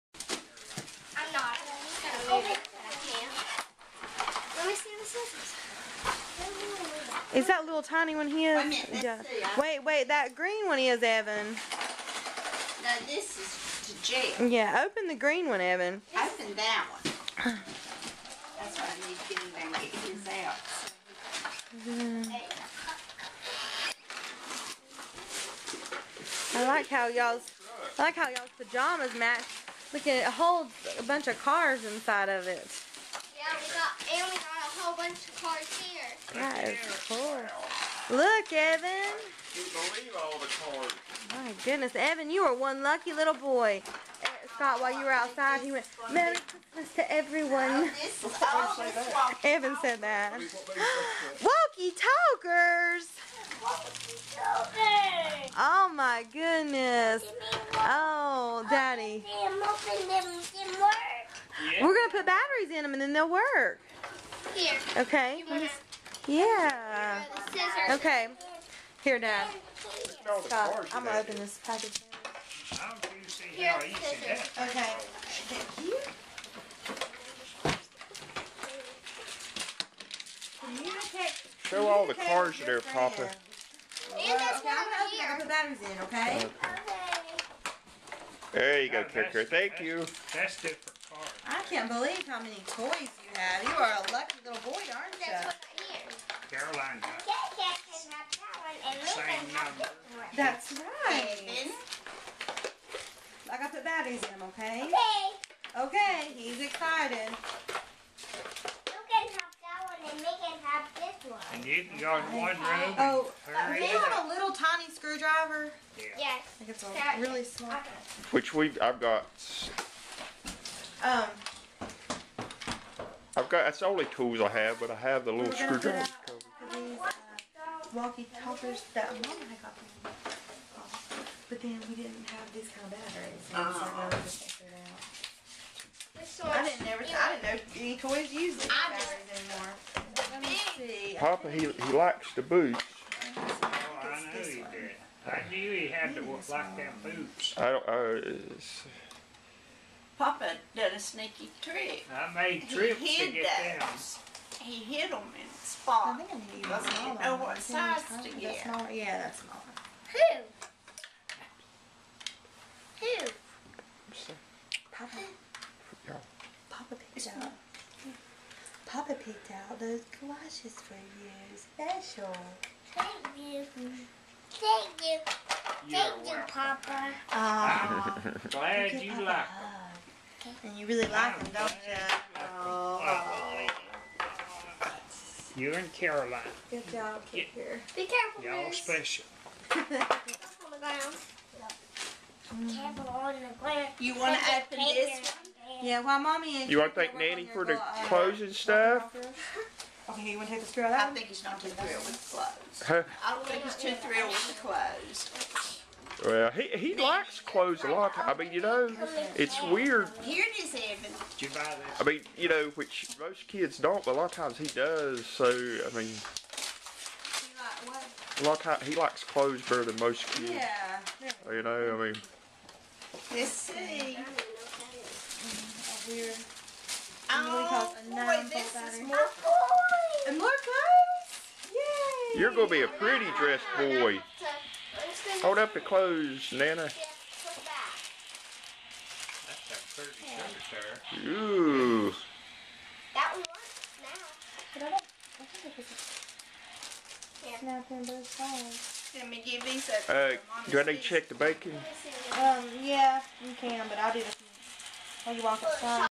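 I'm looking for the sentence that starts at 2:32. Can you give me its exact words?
I made trips he to get those.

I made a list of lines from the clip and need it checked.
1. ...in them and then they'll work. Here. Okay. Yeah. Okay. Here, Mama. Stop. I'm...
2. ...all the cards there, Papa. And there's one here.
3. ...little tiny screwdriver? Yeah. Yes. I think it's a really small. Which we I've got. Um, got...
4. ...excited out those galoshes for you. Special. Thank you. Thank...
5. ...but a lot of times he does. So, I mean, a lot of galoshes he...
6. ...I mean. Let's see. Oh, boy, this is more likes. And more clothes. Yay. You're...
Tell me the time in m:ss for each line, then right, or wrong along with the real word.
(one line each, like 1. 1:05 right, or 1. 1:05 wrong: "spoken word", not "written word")
1. 1:02 wrong: "Dad", not "Mama"
2. 1:21 right
3. 1:54 right
4. 2:49 wrong: "picked", not "excited"
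5. 3:34 wrong: "times", not "galoshes"
6. 3:41 wrong: "clothes", not "likes".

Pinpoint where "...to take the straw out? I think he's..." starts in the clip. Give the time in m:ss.
3:20.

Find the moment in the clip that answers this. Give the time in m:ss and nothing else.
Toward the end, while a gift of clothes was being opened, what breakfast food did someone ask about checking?
4:11.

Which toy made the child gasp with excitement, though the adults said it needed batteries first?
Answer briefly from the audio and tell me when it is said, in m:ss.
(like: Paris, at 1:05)
Walkie talkies, at 0:50.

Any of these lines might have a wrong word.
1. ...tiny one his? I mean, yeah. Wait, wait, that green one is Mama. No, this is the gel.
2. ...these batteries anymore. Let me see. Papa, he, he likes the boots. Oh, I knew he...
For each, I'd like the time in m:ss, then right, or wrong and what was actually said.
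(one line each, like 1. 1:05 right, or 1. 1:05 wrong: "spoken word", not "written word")
1. 0:07 wrong: "Evan", not "Mama"
2. 2:18 right.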